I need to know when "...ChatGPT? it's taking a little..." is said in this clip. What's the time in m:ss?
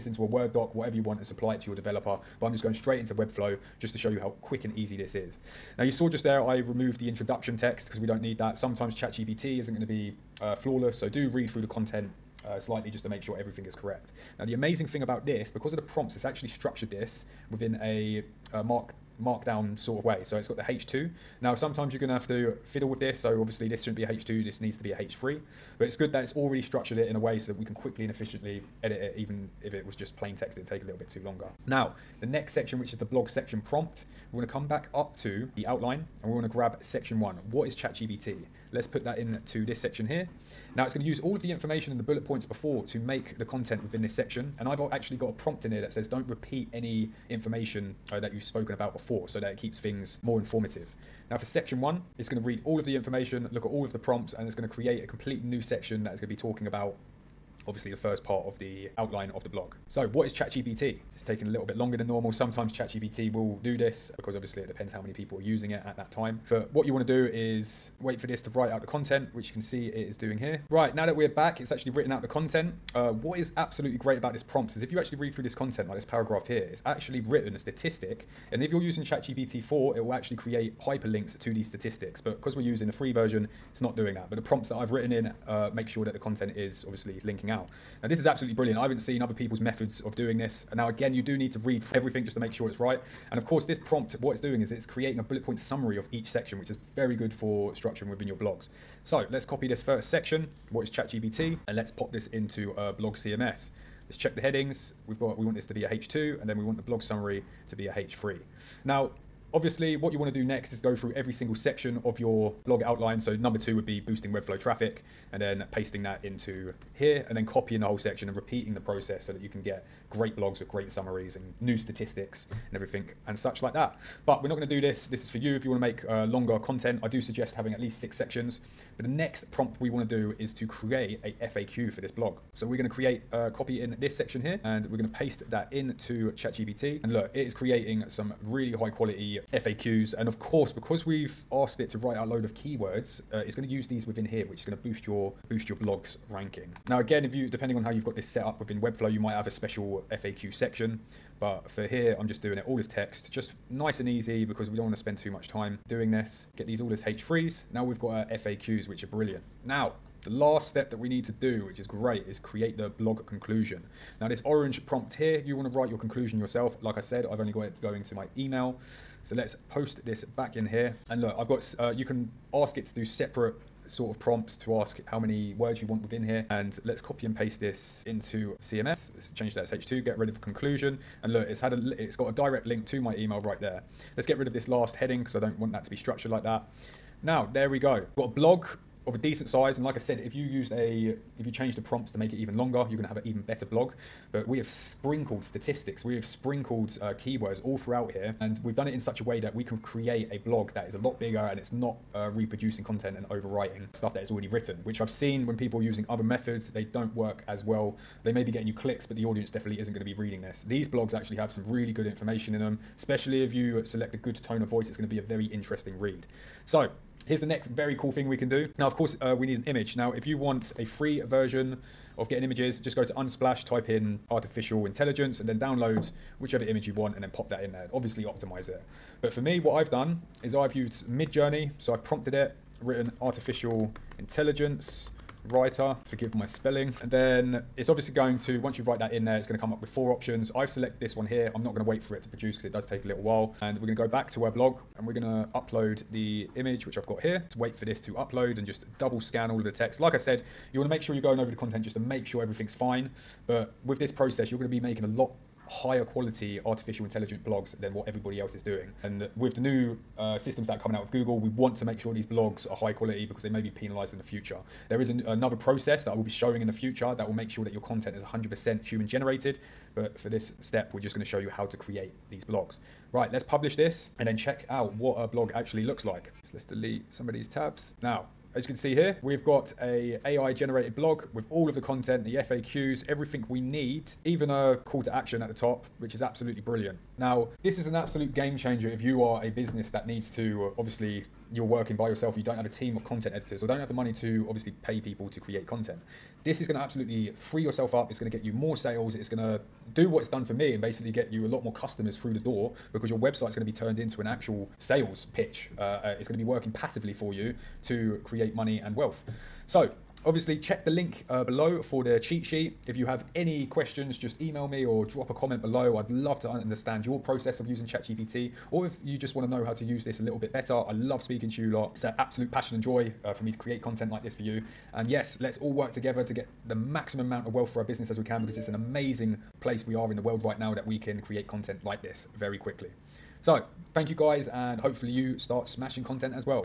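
1:00.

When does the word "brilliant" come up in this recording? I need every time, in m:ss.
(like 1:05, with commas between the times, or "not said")
1:28, 2:39, 4:46.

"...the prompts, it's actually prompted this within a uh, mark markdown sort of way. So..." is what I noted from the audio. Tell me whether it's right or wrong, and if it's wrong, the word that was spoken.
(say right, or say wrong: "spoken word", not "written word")
wrong: "structured", not "prompted".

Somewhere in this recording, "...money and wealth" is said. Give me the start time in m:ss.
5:08.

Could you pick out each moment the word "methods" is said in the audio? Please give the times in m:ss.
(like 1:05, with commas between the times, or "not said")
1:29, 3:26.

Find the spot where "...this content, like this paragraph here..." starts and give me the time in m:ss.
1:15.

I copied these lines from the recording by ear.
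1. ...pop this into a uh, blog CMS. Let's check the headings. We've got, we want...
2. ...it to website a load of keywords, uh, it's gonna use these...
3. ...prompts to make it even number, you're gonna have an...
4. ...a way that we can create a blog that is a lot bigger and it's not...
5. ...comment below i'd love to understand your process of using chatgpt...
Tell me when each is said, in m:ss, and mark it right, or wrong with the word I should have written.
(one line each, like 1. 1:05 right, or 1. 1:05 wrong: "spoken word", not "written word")
1. 1:41 right
2. 2:21 wrong: "write", not "website"
3. 3:11 wrong: "longer", not "number"
4. 3:19 right
5. 5:15 right.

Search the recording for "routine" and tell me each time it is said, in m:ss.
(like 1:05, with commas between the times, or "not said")
not said.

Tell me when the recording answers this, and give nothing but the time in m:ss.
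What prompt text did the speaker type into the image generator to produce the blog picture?
3:53.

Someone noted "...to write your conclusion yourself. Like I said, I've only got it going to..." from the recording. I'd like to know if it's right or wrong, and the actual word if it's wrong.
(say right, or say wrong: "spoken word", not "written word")
right.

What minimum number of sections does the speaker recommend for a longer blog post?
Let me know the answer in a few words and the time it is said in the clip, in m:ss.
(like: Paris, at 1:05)
6, at 2:07.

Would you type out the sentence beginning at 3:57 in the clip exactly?
And then it's obviously going to, once you write that in there, it's gonna come up with four options.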